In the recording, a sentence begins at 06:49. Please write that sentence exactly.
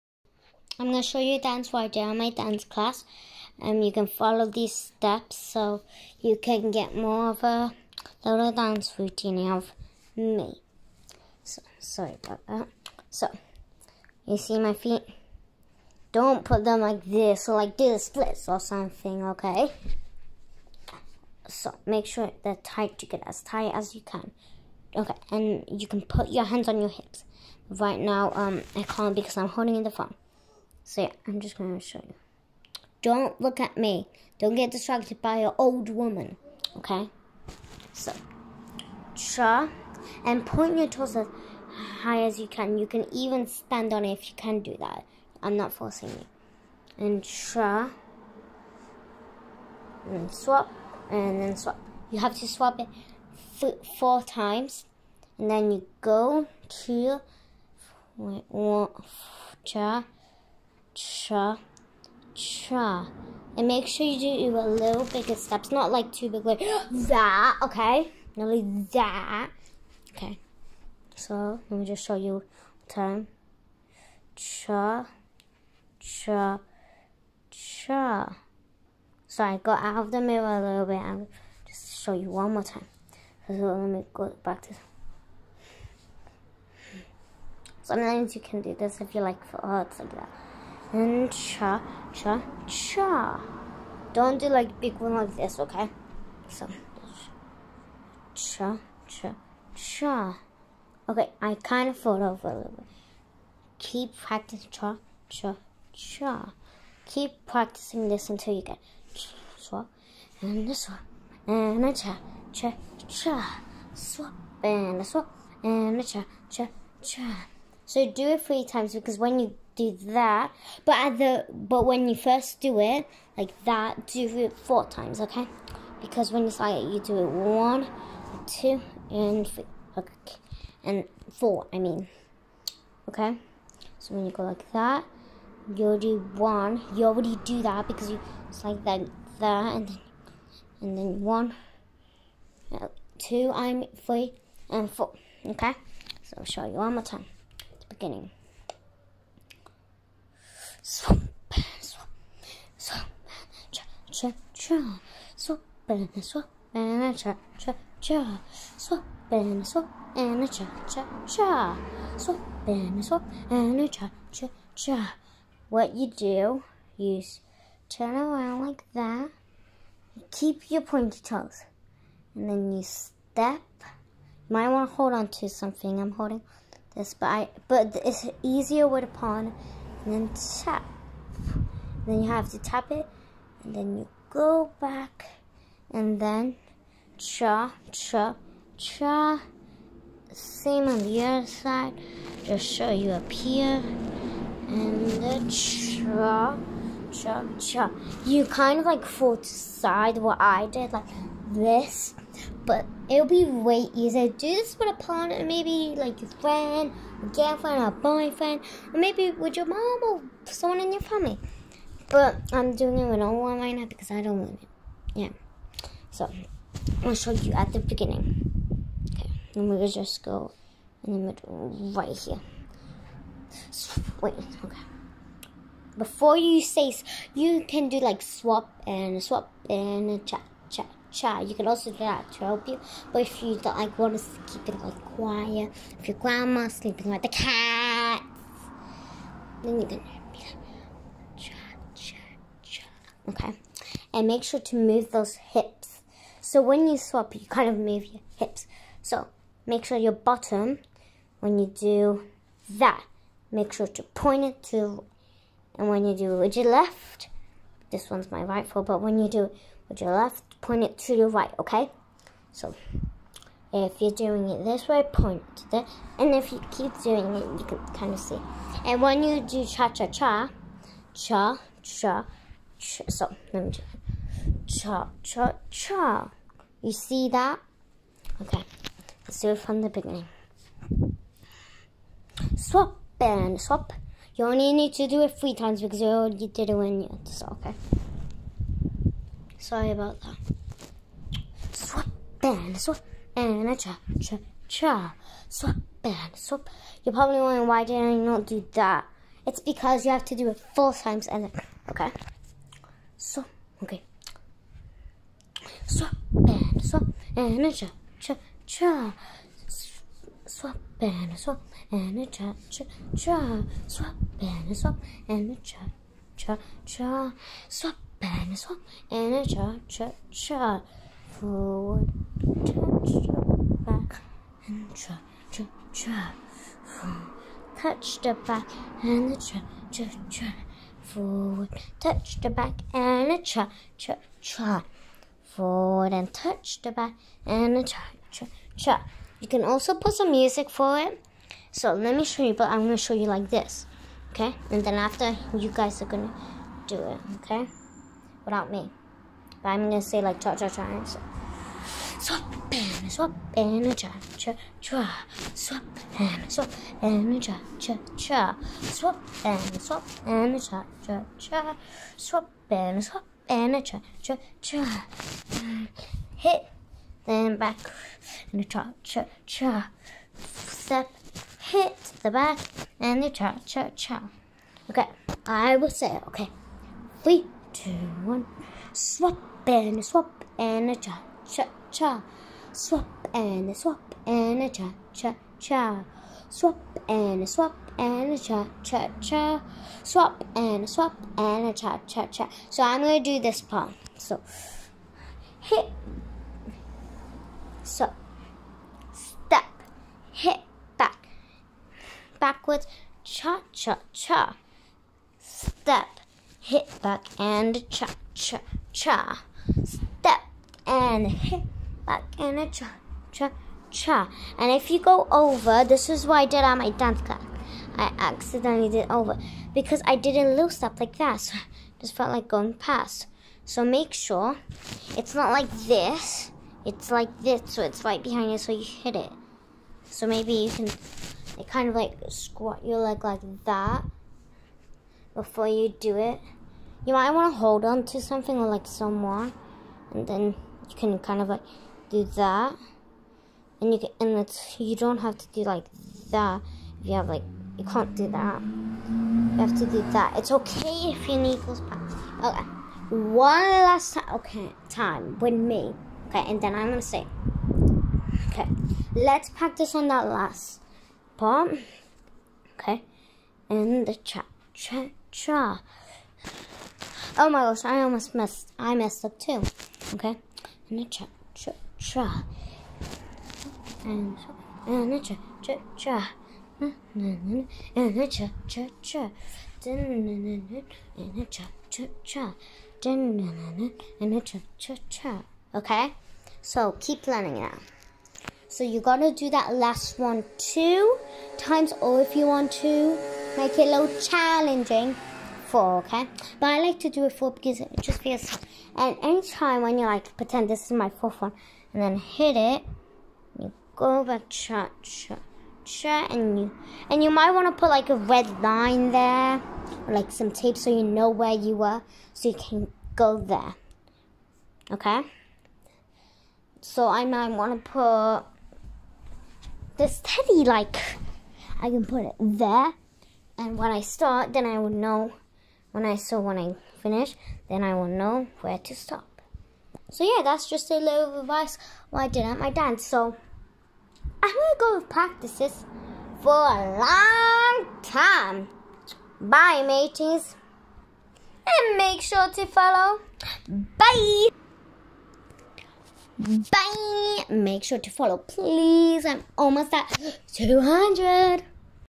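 Step, and hip, back, and a cha, cha, cha.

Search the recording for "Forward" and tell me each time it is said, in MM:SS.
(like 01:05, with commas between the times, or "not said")
05:21, 05:31, 05:35.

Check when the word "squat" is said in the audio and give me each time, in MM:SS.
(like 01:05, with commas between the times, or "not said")
07:12.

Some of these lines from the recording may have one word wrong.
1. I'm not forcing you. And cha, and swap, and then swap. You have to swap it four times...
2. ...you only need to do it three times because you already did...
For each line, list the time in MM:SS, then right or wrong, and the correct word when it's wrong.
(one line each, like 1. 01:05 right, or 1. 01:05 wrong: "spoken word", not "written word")
1. 00:45 right
2. 04:44 right.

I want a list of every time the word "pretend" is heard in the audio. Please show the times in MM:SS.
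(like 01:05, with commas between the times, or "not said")
08:20.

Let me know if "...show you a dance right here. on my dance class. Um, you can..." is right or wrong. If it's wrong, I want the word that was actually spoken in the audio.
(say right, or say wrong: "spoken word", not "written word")
right.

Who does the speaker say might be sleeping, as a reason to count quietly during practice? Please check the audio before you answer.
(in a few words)
Grandma.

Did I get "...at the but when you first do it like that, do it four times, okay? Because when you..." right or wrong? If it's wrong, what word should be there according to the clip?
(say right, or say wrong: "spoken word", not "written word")
right.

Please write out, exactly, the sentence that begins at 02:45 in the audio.
What you do, you turn around like that, keep your pointy toes, and then you step.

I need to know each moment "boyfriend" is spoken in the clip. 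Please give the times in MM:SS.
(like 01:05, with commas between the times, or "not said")
03:27.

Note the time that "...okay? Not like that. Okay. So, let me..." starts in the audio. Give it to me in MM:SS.
01:07.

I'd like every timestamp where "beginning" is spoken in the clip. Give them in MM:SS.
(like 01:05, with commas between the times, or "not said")
02:27, 03:37, 04:39.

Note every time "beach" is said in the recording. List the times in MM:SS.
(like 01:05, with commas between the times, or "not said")
not said.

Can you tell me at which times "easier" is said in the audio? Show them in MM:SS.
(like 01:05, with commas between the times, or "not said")
02:58, 03:23.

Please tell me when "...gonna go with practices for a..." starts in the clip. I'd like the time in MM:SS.
08:54.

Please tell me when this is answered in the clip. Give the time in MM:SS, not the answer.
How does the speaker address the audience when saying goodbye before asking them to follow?
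08:59.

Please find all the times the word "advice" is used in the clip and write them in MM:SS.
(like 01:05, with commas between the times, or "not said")
08:51.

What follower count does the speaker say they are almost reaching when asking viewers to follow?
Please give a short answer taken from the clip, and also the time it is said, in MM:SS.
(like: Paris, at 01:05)
200, at 09:10.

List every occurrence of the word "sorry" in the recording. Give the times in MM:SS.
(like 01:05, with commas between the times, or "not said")
00:11, 04:49.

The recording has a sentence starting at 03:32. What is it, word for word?
But I'm doing it with no one right now because I don't want it.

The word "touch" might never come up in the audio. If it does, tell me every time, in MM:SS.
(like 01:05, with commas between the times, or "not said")
05:22, 05:27, 05:32, 05:36.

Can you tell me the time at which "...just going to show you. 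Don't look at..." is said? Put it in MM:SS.
00:31.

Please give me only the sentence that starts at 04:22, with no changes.
So, if you're doing it this way, point to this, and if you keep doing it, you can kind of see.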